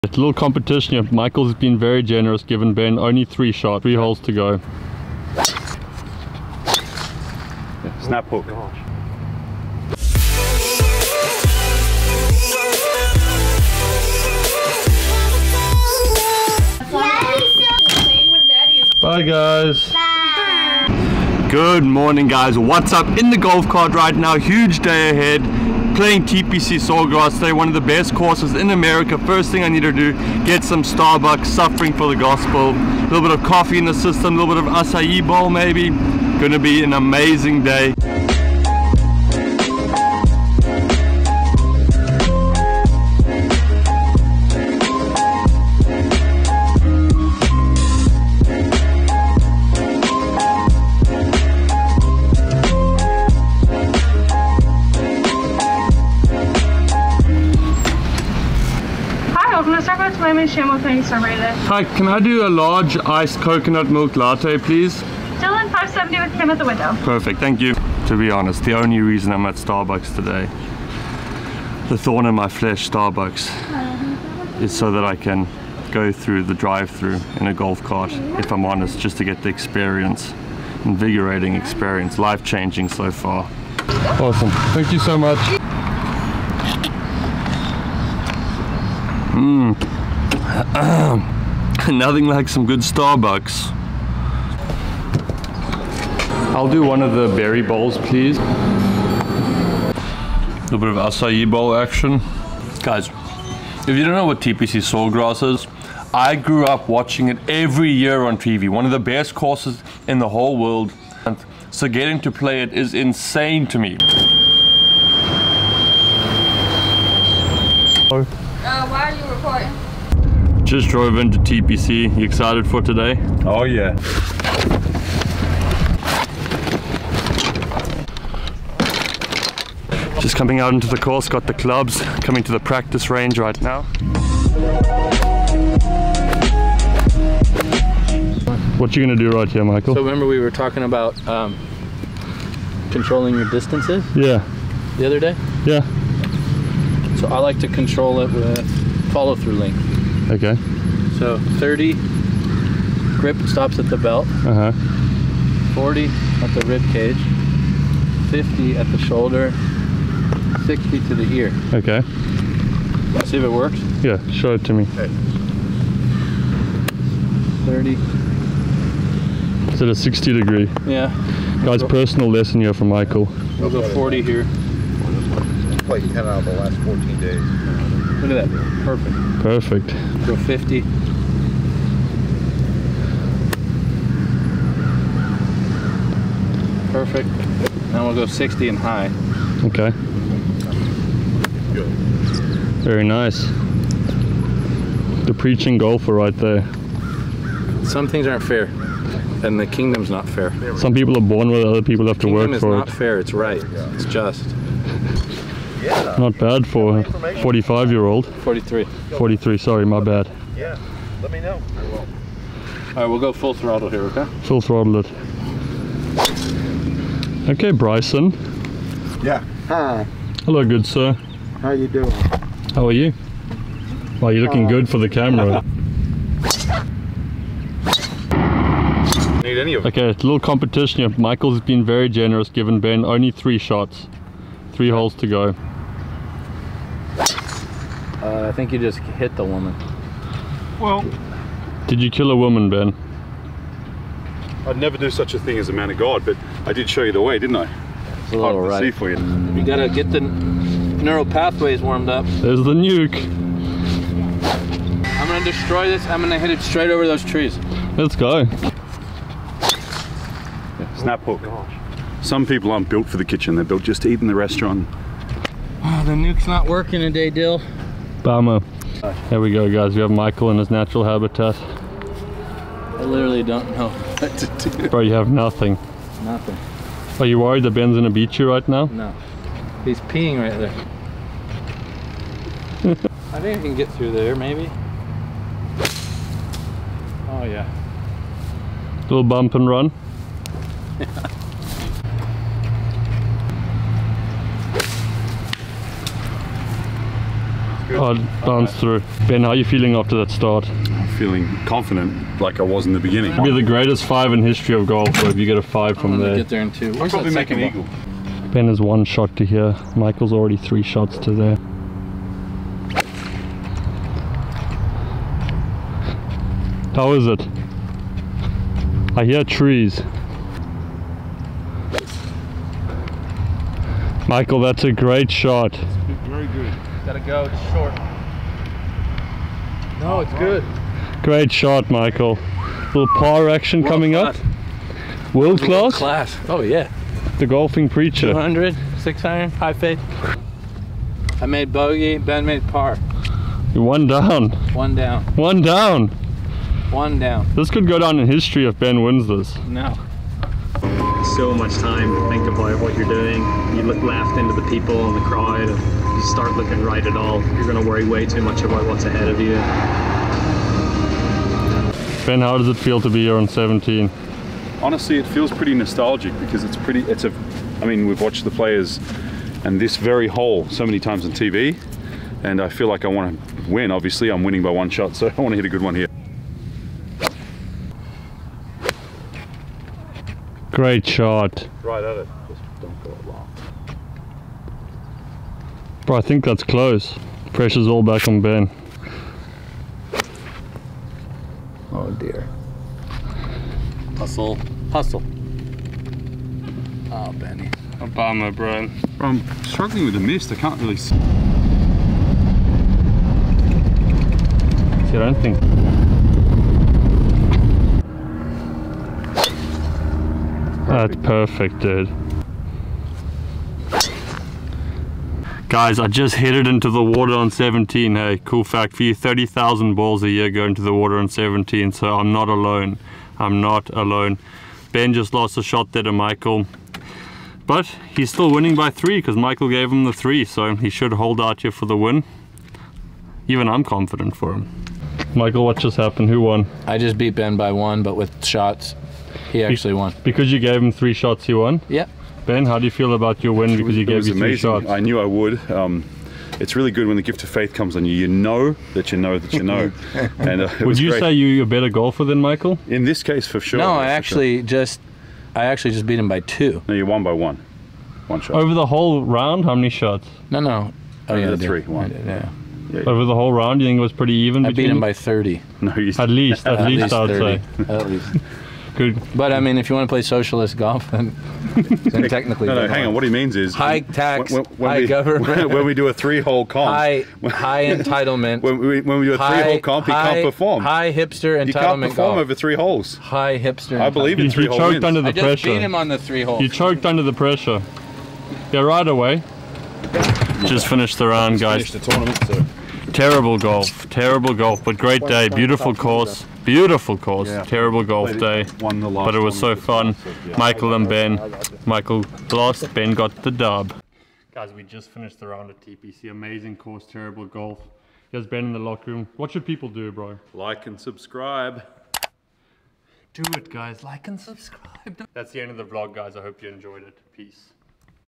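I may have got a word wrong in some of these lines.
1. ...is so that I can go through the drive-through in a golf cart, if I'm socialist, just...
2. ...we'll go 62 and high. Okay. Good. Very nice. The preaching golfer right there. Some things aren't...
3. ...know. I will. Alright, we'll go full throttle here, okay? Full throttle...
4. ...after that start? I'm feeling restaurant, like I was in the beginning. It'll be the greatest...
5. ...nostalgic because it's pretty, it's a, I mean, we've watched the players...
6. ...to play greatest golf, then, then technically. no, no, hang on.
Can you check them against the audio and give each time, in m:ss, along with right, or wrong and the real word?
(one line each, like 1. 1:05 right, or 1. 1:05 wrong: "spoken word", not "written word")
1. 1:14 wrong: "honest", not "socialist"
2. 3:08 wrong: "60", not "62"
3. 3:31 right
4. 4:59 wrong: "confident", not "restaurant"
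5. 6:05 right
6. 7:50 wrong: "socialist", not "greatest".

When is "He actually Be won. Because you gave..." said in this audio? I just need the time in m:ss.
7:19.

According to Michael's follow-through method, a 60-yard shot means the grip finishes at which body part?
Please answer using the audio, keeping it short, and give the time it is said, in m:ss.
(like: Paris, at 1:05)
Ear, at 2:41.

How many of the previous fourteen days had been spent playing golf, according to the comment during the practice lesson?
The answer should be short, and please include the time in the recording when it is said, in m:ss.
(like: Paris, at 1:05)
10, at 2:56.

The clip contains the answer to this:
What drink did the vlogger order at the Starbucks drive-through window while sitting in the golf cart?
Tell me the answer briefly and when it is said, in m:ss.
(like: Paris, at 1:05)
Large iced coconut milk latte, at 1:02.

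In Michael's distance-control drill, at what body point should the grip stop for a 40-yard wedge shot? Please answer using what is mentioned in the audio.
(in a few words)
Rib cage.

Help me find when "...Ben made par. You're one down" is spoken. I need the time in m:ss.
5:42.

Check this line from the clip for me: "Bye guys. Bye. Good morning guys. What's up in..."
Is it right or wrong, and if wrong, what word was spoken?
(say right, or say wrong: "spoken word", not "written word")
right.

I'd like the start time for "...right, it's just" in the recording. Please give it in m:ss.
3:23.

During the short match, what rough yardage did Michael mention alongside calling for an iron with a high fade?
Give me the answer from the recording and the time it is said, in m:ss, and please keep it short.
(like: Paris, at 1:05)
200, at 5:38.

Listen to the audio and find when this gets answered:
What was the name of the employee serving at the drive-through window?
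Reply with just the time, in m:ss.
1:06.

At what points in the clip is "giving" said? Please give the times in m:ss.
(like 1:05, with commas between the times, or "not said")
0:02, 3:52.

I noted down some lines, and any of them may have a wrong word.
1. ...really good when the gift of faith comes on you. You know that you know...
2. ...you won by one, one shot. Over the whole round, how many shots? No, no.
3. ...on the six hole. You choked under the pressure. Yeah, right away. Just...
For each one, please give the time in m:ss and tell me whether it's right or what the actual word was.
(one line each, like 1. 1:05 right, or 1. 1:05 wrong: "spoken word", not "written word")
1. 7:26 right
2. 7:36 right
3. 8:05 wrong: "three", not "six".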